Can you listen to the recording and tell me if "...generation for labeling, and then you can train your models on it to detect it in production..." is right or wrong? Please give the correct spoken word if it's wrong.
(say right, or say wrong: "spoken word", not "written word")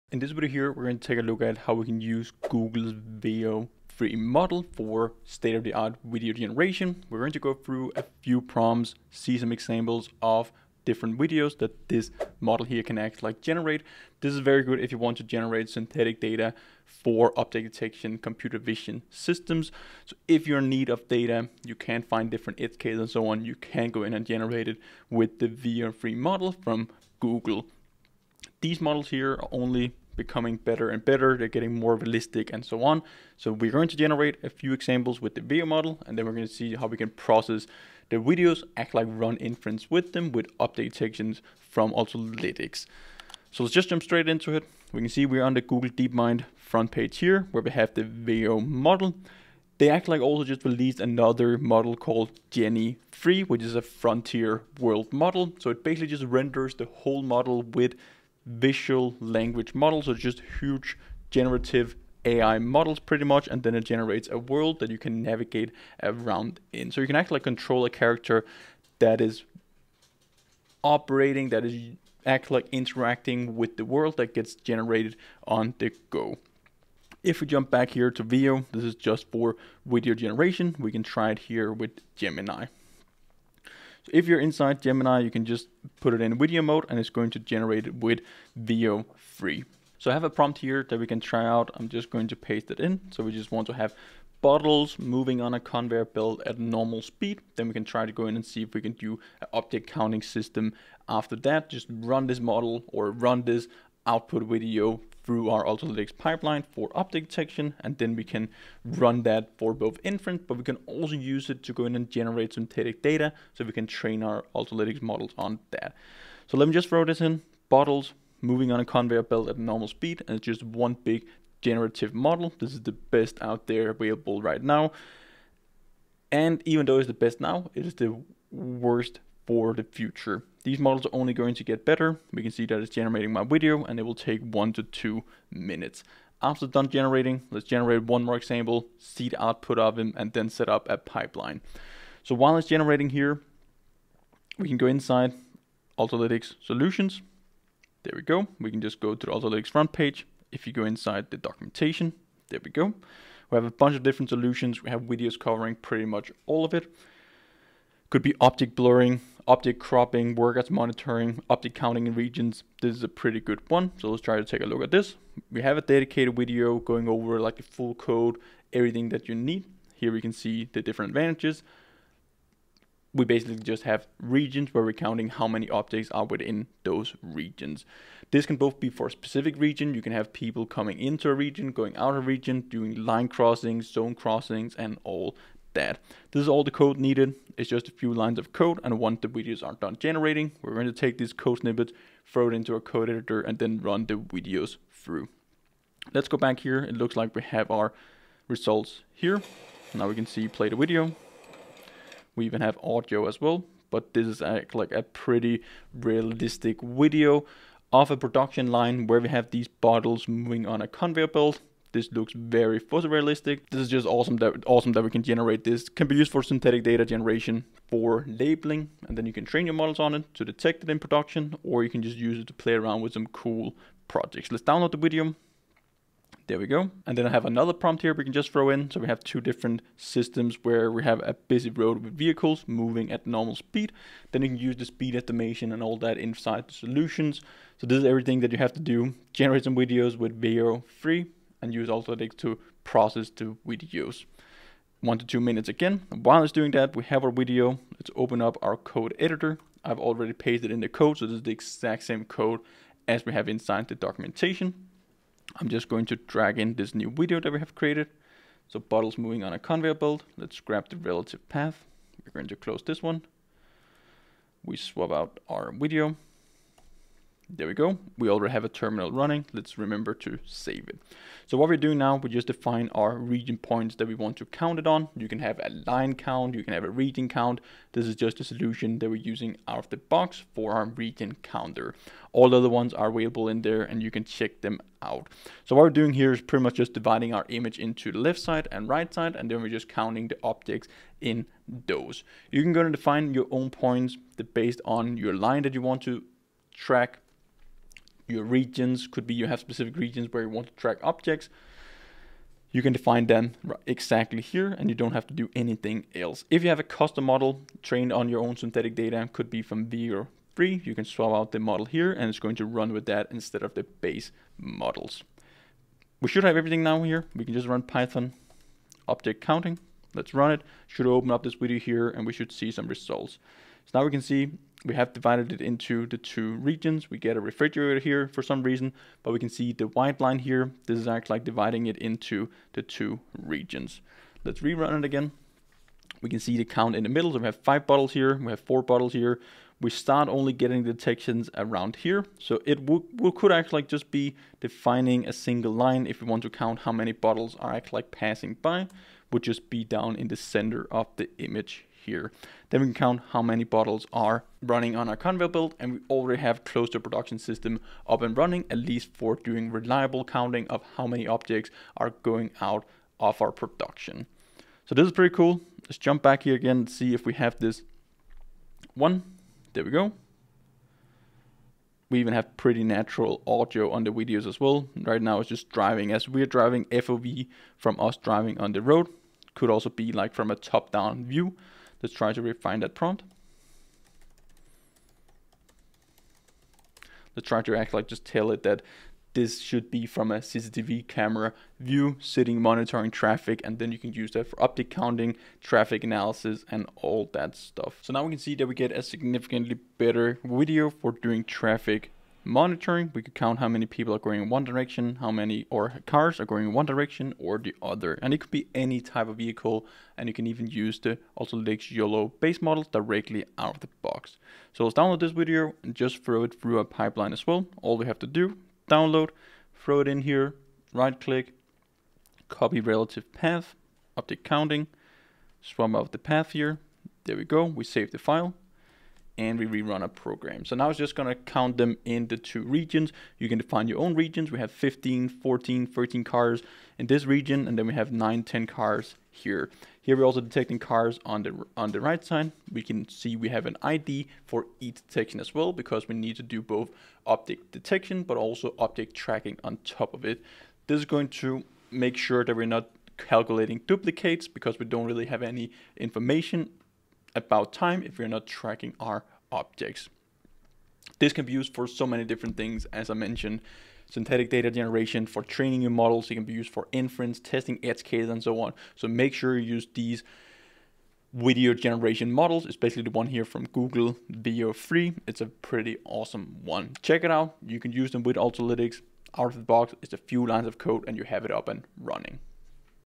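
right.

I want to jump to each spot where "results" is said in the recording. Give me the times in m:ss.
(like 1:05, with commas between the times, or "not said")
3:18, 5:22.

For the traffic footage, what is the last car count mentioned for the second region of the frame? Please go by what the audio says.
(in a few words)
10.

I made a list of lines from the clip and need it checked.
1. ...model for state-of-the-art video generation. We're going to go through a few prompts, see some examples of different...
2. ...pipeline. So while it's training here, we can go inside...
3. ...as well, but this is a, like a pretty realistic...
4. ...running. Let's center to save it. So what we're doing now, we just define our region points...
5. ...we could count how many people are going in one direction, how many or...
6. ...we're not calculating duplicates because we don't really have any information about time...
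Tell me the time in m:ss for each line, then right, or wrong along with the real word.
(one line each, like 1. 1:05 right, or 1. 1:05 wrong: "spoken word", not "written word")
1. 0:04 right
2. 2:20 wrong: "generating", not "training"
3. 3:23 right
4. 4:29 wrong: "remember", not "center"
5. 6:43 right
6. 7:32 right.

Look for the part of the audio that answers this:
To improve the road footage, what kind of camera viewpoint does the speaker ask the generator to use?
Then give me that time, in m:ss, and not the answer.
6:30.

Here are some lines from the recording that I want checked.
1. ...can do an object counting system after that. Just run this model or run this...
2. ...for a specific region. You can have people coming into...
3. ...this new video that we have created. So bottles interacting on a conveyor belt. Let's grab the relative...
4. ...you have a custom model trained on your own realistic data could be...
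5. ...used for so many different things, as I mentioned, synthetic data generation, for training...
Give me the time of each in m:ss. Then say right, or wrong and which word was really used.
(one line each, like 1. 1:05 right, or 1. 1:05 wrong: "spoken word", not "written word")
1. 1:38 right
2. 2:58 right
3. 4:16 wrong: "moving", not "interacting"
4. 5:06 wrong: "synthetic", not "realistic"
5. 7:41 right.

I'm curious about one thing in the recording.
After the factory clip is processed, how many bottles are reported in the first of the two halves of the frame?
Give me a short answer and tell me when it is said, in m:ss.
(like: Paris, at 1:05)
5, at 5:37.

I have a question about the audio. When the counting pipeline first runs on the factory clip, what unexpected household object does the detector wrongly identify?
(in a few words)
Refrigerator.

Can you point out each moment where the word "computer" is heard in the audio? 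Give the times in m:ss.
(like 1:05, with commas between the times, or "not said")
0:18.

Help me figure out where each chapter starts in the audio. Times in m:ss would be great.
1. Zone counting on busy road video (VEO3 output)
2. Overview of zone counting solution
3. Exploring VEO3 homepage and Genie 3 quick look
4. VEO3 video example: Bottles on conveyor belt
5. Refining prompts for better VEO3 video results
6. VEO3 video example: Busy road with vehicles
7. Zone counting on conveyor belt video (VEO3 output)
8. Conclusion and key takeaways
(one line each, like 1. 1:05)
1. 6:54
2. 2:23
3. 0:42
4. 1:22
5. 6:04
6. 3:45
7. 4:06
8. 7:40.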